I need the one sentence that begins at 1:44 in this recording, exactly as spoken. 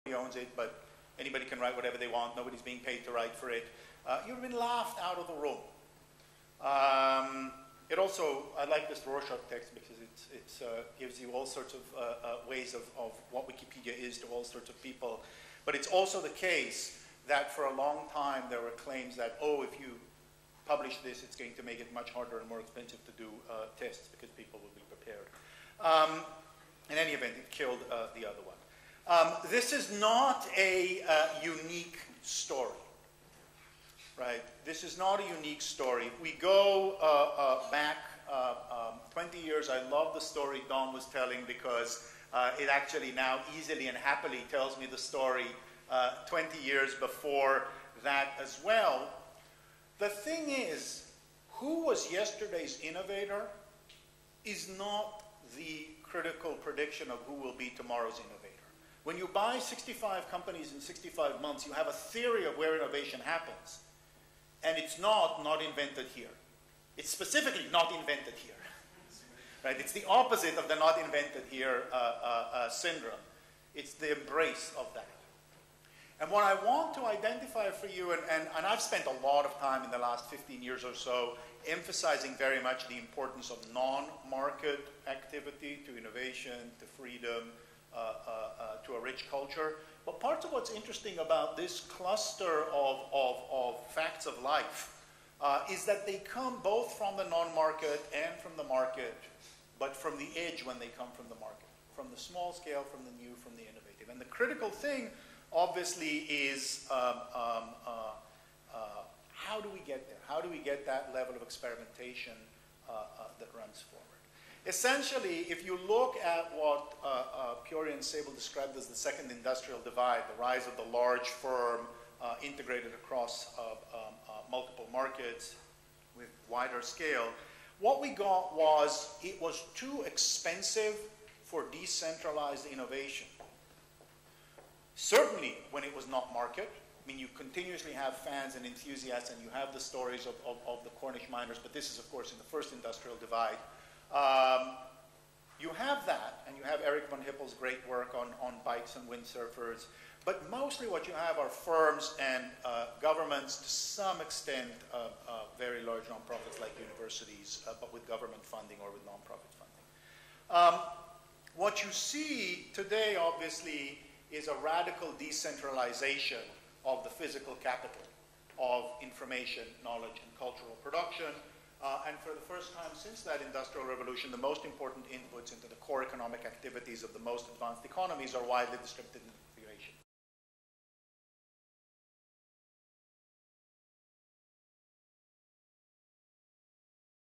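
And the critical thing, obviously, is um, um, uh, uh, how do we get there?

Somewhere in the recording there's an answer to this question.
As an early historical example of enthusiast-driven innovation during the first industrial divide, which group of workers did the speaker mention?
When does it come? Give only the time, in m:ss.
2:20.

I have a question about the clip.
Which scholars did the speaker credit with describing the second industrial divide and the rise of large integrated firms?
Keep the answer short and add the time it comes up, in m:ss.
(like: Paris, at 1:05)
Piore and Sabel, at 1:57.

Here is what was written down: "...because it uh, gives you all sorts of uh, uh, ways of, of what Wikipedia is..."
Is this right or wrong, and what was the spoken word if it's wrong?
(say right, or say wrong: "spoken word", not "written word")
right.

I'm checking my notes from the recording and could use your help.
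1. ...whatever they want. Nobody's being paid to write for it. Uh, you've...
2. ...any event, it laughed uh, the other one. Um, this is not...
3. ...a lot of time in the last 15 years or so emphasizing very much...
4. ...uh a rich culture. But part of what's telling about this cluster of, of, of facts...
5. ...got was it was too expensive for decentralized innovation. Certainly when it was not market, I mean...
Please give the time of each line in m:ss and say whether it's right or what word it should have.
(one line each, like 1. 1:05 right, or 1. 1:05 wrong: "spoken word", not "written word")
1. 0:01 right
2. 0:26 wrong: "killed", not "laughed"
3. 1:19 right
4. 1:27 wrong: "interesting", not "telling"
5. 2:08 right.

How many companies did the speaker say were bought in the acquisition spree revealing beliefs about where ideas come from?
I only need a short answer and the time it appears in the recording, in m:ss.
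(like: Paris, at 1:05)
65, at 0:59.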